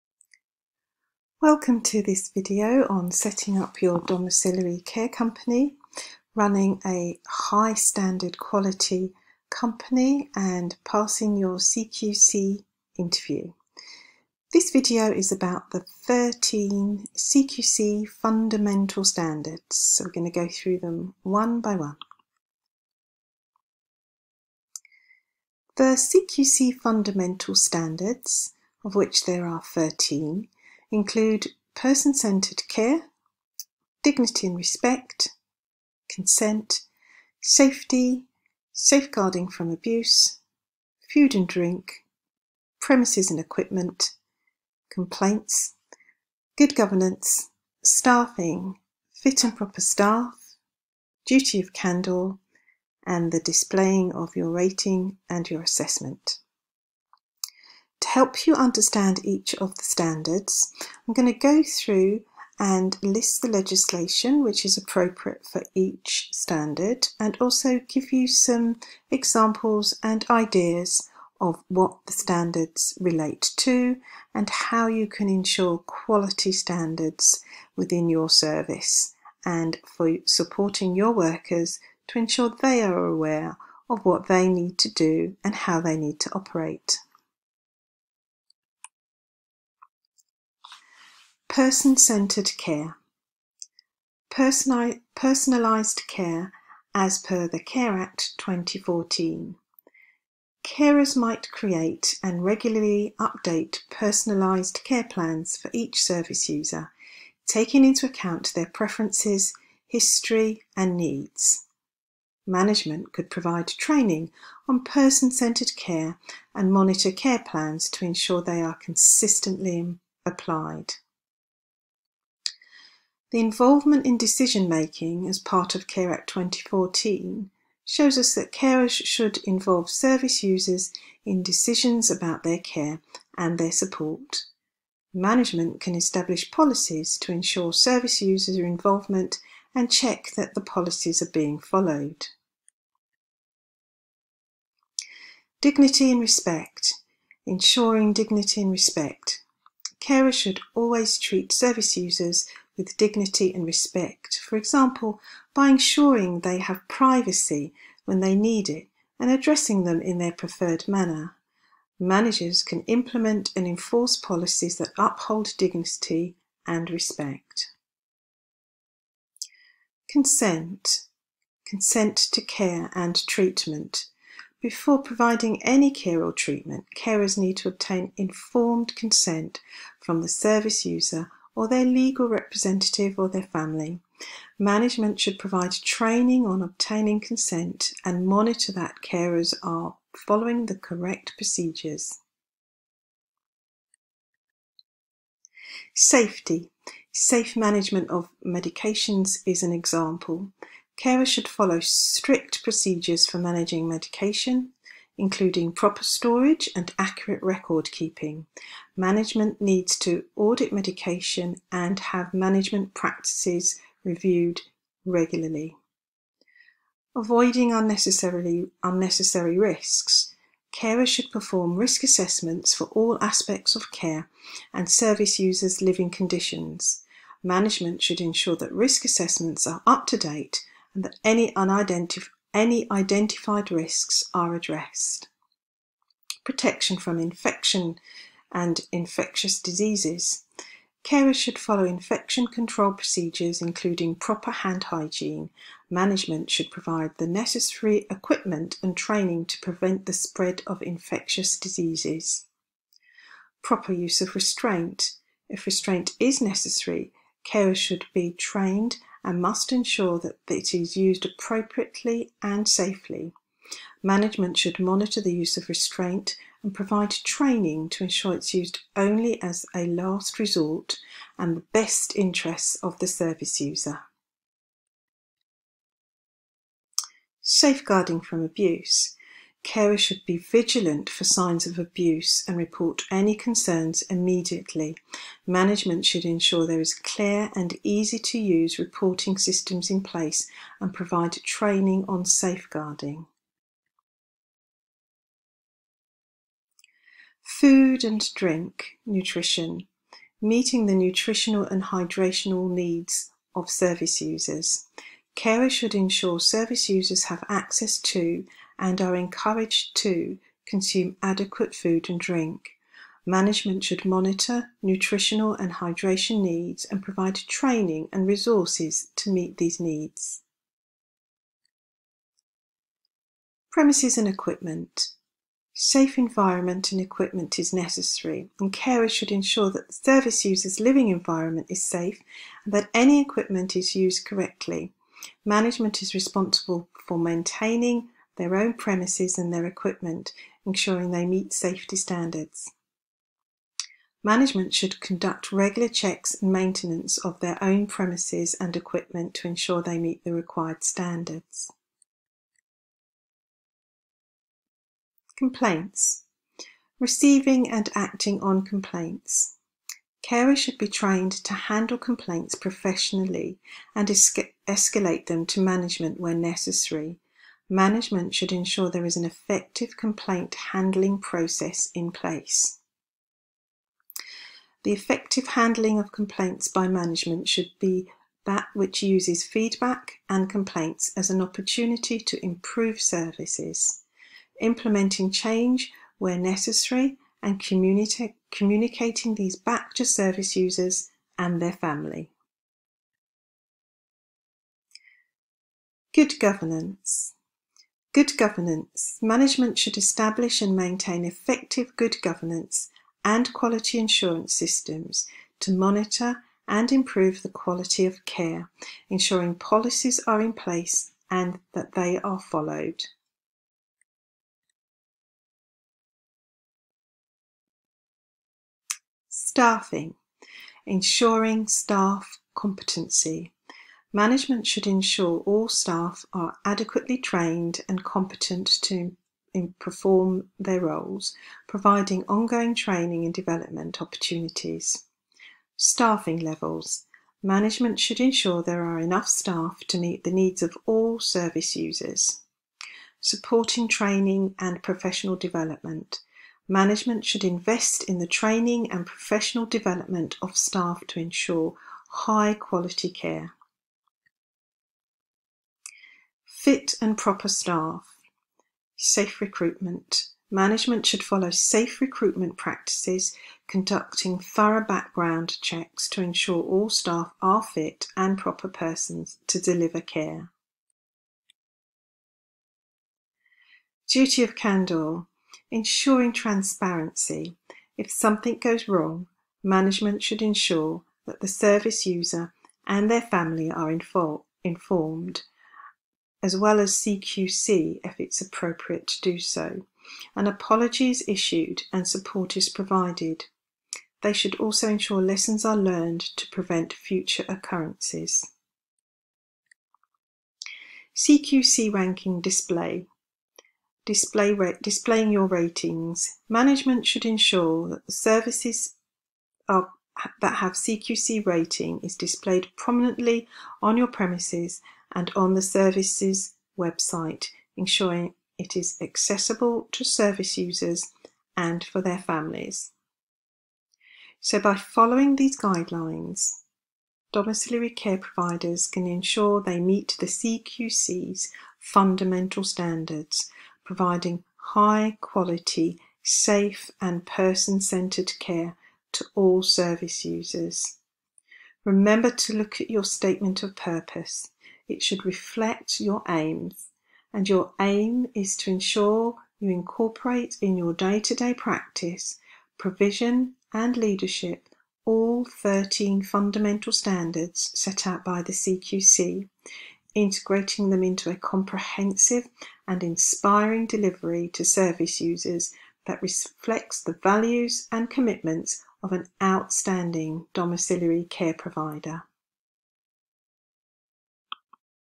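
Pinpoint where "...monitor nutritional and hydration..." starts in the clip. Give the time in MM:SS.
05:14.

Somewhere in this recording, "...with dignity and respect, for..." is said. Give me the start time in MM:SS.
02:32.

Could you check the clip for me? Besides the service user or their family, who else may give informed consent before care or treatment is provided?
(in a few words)
legal representative.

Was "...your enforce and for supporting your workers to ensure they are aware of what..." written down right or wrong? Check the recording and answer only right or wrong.
wrong.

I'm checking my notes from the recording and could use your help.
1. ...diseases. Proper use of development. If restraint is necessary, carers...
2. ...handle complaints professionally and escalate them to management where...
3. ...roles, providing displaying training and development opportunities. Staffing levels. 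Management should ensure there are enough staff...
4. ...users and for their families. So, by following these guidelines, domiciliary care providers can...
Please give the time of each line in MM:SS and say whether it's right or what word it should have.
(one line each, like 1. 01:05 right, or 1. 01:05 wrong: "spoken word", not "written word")
1. 04:11 wrong: "restraint", not "development"
2. 06:01 right
3. 07:10 wrong: "ongoing", not "displaying"
4. 08:40 right.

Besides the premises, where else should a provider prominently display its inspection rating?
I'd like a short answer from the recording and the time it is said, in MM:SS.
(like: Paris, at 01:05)
service's website, at 08:35.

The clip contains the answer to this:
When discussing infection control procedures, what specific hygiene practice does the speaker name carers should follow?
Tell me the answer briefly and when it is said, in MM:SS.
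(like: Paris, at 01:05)
hand hygiene, at 04:04.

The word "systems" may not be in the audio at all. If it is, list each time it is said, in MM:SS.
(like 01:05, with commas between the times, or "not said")
04:49, 06:44.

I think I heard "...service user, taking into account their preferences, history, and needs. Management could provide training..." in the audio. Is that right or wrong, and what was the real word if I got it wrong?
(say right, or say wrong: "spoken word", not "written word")
right.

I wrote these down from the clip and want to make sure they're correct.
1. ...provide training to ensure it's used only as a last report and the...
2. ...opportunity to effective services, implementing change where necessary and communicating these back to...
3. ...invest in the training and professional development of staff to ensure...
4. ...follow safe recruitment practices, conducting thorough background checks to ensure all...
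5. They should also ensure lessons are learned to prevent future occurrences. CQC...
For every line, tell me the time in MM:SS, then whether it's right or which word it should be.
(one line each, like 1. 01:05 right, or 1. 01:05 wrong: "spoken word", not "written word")
1. 04:26 wrong: "resort", not "report"
2. 06:21 wrong: "improve", not "effective"
3. 07:27 right
4. 07:41 right
5. 08:14 right.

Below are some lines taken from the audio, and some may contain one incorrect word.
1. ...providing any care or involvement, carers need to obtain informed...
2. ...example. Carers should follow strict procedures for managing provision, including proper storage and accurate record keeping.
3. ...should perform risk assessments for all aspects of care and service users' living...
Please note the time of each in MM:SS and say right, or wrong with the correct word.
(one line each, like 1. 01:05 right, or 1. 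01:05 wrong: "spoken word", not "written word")
1. 02:55 wrong: "treatment", not "involvement"
2. 03:19 wrong: "medication", not "provision"
3. 03:41 right.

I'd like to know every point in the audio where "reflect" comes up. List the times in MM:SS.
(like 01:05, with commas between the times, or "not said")
09:05, 09:26.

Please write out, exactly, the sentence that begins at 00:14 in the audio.
This video is about the 13 CQC fundamental standards.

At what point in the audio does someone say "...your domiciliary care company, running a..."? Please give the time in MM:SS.
00:03.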